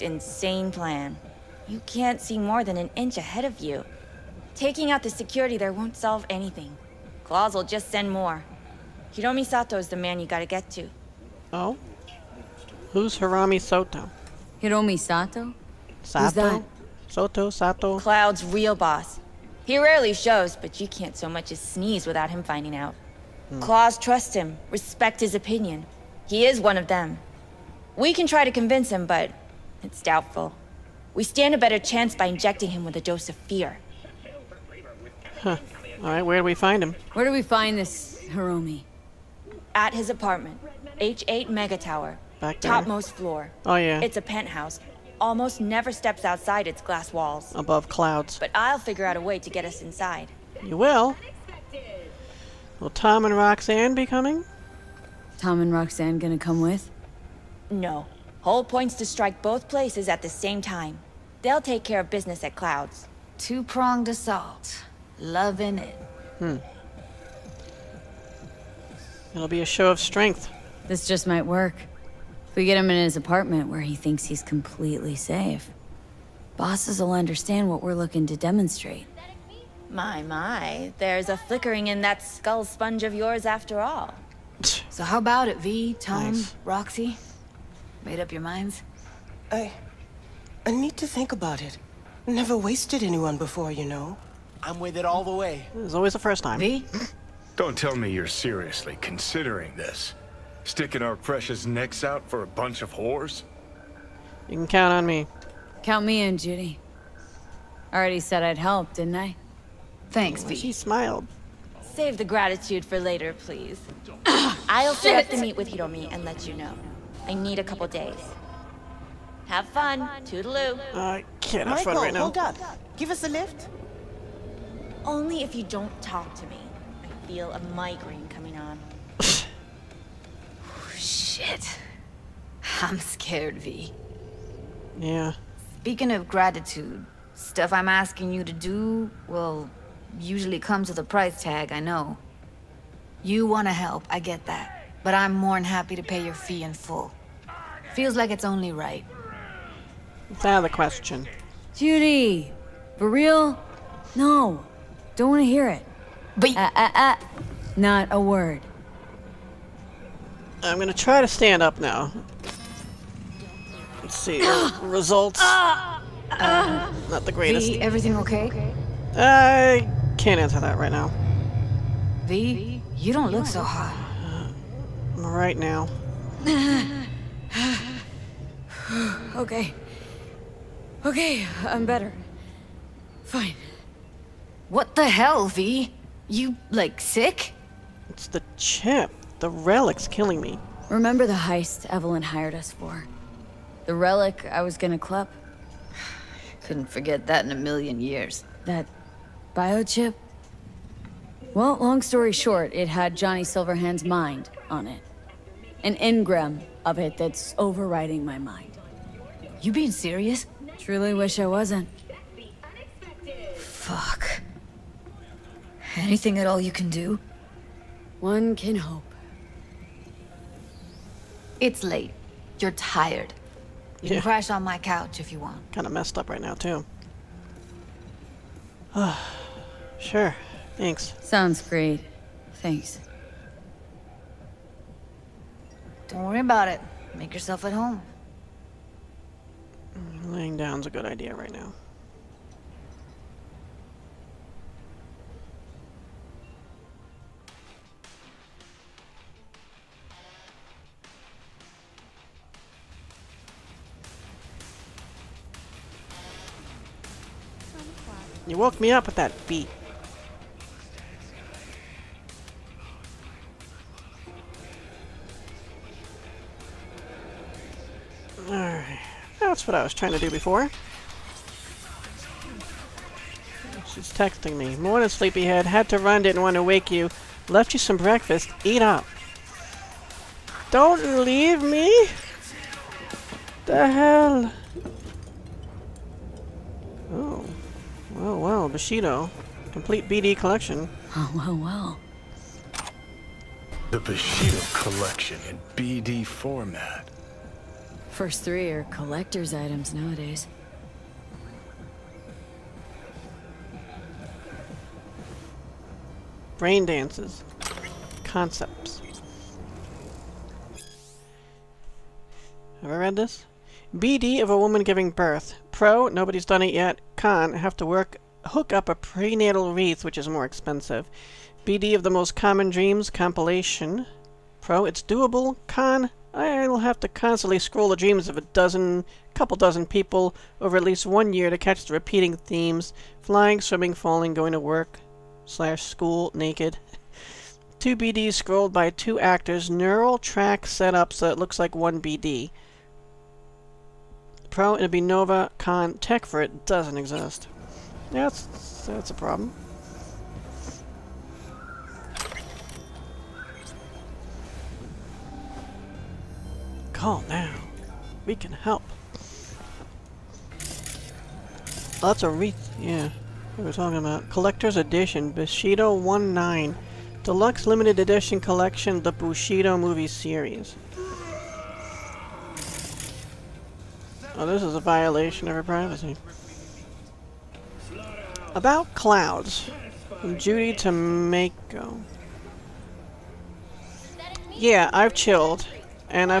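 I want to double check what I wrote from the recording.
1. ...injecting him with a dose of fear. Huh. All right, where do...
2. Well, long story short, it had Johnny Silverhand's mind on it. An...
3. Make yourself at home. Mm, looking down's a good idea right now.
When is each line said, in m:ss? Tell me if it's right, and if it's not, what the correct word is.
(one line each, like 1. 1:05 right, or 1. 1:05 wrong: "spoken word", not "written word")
1. 0:32 right
2. 3:21 right
3. 3:57 wrong: "laying", not "looking".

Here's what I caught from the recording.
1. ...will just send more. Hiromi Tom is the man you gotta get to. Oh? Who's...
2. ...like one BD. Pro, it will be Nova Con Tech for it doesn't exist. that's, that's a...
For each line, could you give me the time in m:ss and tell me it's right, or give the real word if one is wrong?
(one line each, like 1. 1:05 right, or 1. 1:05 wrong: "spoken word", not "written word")
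1. 0:07 wrong: "Sato", not "Tom"
2. 5:41 right.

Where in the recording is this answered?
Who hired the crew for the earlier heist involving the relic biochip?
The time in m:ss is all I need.
3:11.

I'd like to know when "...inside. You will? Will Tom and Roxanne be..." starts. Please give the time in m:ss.
0:49.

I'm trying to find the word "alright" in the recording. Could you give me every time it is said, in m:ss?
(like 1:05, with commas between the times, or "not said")
2:55, 4:28.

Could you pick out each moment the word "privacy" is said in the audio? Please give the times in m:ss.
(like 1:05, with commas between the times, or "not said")
6:15.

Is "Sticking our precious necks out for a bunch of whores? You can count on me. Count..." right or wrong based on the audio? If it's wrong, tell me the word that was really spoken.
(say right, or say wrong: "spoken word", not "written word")
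right.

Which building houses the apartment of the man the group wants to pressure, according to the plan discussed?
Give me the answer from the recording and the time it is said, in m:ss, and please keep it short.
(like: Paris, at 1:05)
H8 Mega Tower, at 0:41.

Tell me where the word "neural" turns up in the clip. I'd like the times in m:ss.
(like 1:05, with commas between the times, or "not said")
5:39.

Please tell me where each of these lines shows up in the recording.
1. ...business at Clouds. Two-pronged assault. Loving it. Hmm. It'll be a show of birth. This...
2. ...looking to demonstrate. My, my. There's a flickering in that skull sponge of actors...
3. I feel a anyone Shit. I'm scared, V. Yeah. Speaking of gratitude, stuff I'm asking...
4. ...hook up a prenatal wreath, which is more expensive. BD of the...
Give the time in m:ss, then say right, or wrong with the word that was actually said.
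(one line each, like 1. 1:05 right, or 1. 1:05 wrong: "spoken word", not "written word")
1. 1:02 wrong: "strength", not "birth"
2. 1:17 wrong: "yours", not "actors"
3. 2:07 wrong: "migraine", not "anyone"
4. 5:18 right.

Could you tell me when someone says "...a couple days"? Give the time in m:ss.
1:57.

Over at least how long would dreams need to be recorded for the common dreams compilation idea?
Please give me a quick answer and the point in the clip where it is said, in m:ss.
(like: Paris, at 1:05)
1 year, at 5:31.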